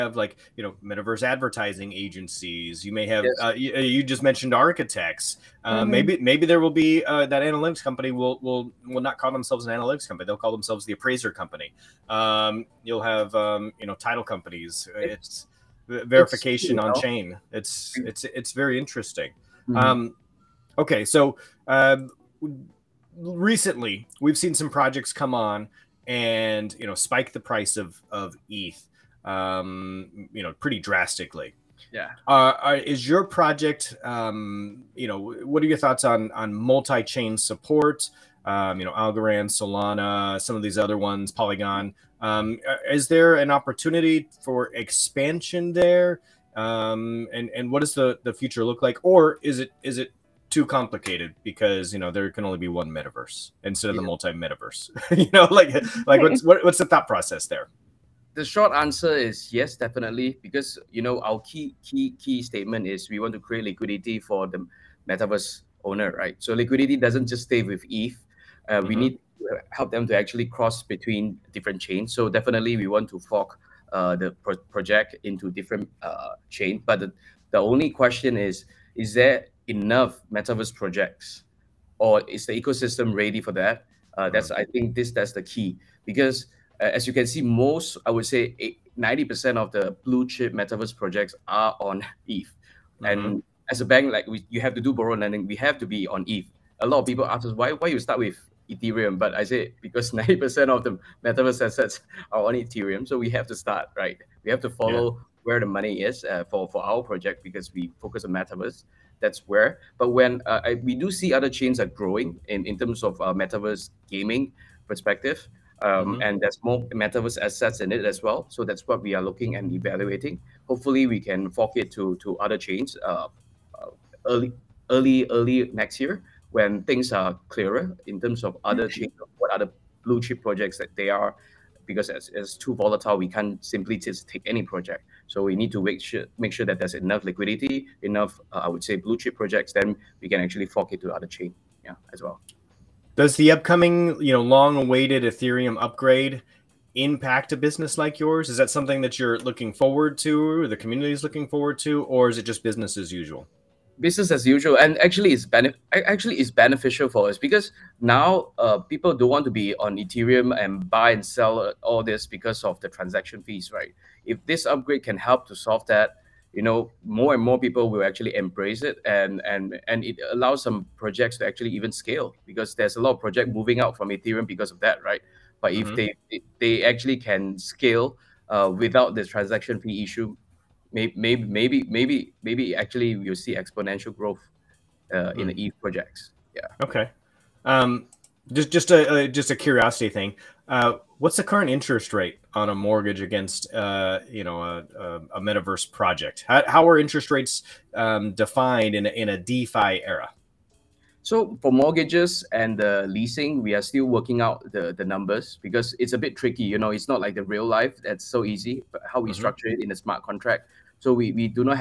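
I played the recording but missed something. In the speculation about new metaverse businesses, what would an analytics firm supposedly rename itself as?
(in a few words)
the appraiser company.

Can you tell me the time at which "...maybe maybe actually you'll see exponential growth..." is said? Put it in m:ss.
3:01.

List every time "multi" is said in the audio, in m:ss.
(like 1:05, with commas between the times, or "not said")
0:36, 0:54.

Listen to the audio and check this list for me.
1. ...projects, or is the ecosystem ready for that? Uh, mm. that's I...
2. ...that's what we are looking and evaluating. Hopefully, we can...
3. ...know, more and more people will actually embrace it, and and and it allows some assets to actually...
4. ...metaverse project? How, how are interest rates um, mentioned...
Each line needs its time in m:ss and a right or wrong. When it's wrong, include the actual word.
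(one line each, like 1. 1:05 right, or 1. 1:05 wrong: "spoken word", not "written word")
1. 1:20 right
2. 1:58 right
3. 2:46 wrong: "projects", not "assets"
4. 3:15 wrong: "defined", not "mentioned".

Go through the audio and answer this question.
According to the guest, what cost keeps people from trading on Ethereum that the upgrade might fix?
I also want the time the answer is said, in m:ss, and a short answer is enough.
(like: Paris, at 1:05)
transaction fees, at 2:42.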